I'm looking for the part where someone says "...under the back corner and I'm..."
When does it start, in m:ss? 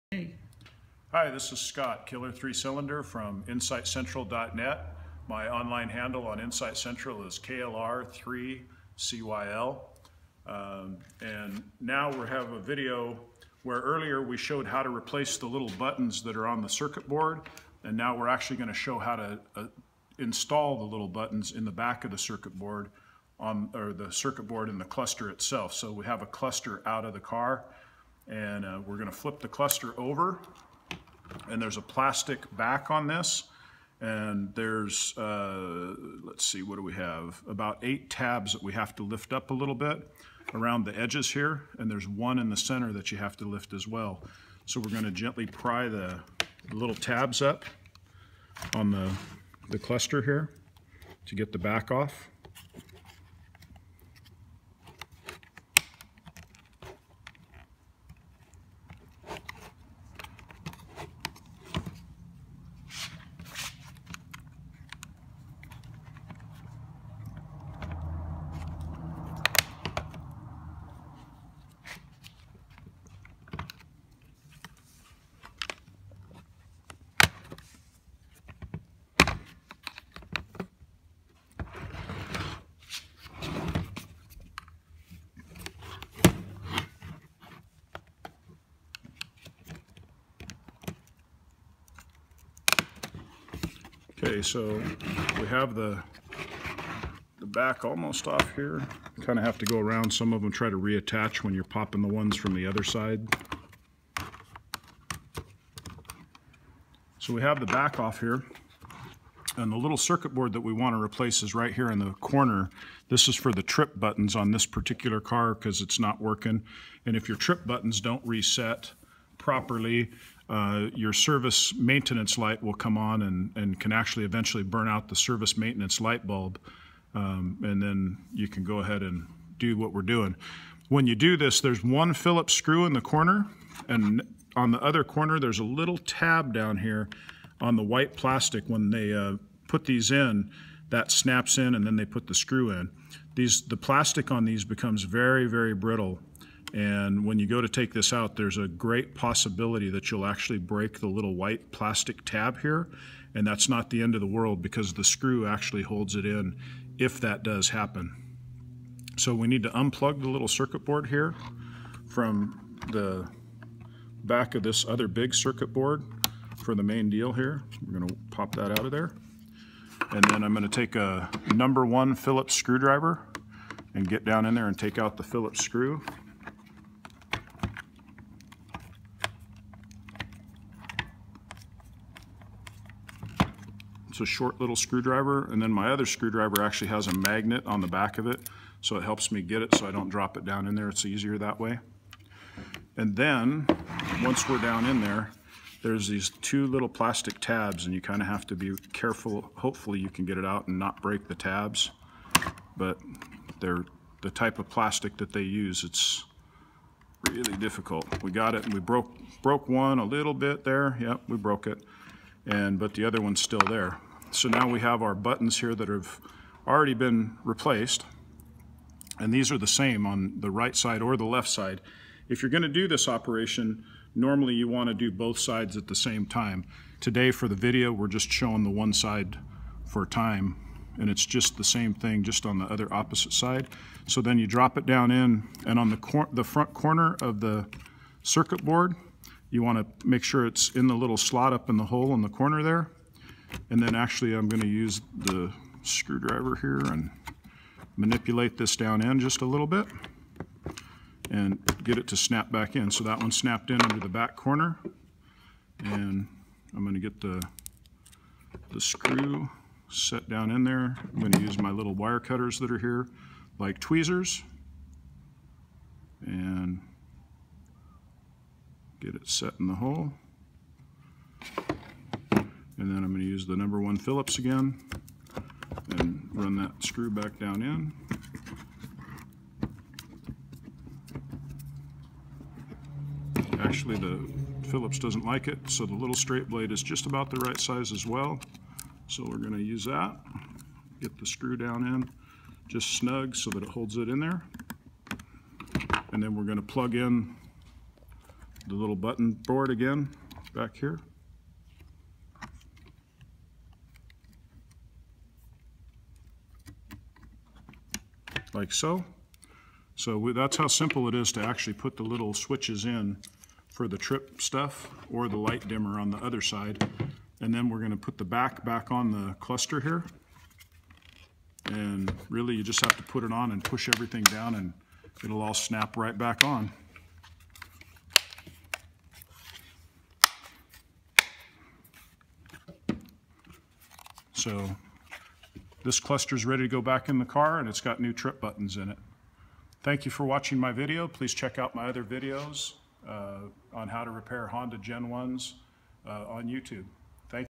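4:13.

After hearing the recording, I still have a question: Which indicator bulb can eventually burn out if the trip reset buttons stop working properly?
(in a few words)
service maintenance light bulb.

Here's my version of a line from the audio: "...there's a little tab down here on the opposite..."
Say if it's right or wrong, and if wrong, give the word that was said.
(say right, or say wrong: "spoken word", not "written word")
wrong: "white", not "opposite".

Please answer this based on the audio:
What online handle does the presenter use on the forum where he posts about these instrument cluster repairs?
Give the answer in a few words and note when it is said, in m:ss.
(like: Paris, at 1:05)
KLR3CYL, at 0:07.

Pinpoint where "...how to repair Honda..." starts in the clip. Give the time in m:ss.
5:43.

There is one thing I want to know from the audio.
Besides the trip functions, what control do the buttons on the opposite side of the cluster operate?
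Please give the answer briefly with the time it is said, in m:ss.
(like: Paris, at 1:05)
light dimmer, at 5:15.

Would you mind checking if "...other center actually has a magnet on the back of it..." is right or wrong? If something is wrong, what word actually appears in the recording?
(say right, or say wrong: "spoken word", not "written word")
wrong: "screwdriver", not "center".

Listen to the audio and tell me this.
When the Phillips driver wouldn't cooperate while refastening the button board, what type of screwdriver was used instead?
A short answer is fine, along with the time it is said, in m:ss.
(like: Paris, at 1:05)
straight blade, at 4:46.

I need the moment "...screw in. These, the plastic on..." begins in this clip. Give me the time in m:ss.
2:22.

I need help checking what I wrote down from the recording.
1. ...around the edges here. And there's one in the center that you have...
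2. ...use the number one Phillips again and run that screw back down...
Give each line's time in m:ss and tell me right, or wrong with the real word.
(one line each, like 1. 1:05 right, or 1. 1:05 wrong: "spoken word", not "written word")
1. 0:40 right
2. 4:33 right.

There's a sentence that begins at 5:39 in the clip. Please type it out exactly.
Thank you for watching my video.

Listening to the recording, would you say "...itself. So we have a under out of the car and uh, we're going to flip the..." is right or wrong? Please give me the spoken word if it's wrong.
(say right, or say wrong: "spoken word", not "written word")
wrong: "cluster", not "under".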